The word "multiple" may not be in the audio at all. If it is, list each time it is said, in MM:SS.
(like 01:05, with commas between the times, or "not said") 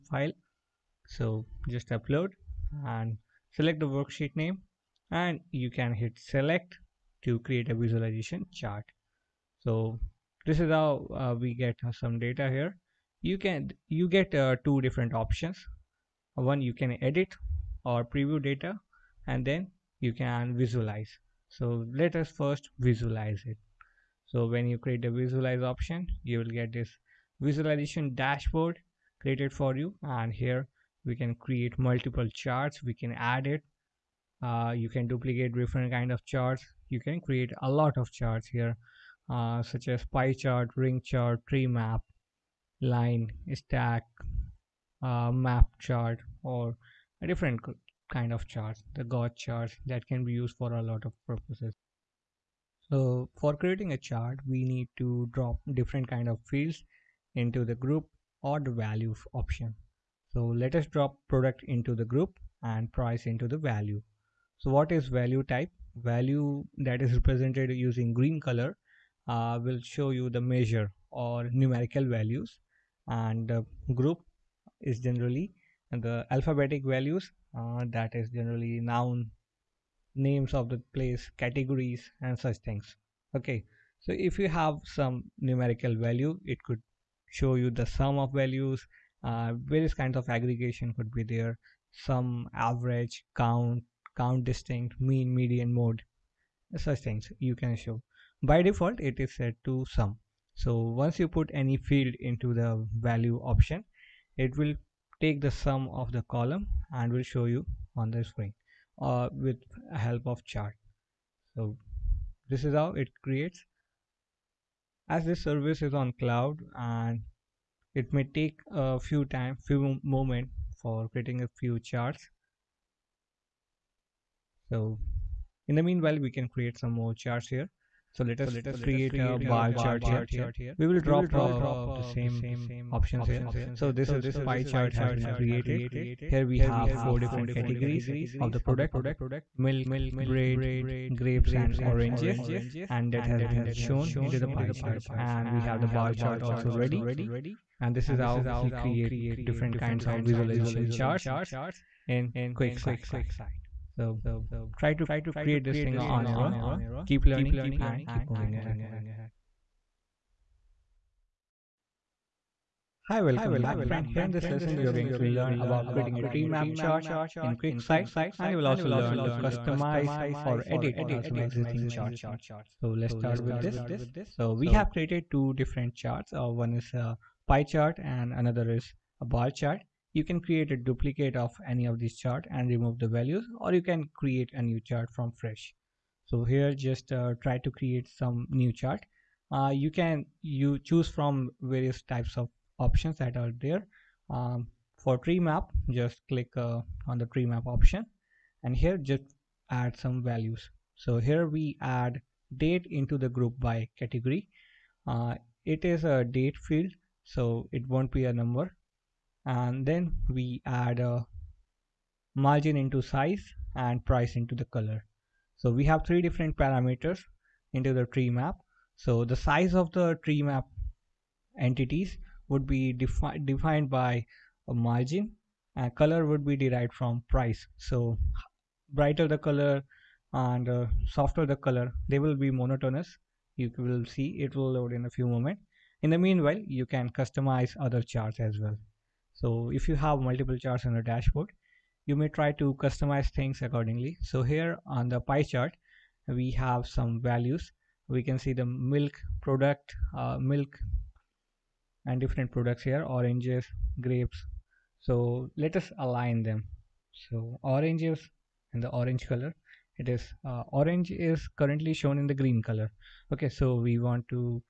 00:31, 04:00.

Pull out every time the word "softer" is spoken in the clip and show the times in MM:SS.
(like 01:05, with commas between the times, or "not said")
03:51.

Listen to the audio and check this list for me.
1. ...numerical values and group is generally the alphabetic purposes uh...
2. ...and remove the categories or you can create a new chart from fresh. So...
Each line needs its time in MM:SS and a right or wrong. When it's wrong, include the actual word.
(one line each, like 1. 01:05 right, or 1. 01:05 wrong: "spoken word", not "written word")
1. 01:11 wrong: "values", not "purposes"
2. 03:02 wrong: "values", not "categories".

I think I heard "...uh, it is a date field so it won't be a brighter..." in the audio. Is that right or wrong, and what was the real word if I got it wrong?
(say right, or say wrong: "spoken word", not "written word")
wrong: "number", not "brighter".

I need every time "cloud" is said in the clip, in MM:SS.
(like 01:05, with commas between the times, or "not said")
01:56.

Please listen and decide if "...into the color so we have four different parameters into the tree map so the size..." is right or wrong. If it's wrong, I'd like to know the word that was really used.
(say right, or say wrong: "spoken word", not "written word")
wrong: "three", not "four".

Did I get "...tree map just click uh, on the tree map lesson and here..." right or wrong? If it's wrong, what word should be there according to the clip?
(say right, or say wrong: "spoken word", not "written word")
wrong: "option", not "lesson".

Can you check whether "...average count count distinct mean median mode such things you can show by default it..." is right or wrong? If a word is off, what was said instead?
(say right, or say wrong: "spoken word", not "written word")
right.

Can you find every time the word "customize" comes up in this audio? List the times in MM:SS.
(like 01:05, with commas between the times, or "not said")
02:49, 03:57, 04:02.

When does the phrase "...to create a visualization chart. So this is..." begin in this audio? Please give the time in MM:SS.
00:07.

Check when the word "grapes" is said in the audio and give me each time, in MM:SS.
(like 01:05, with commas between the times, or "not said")
02:21, 04:14.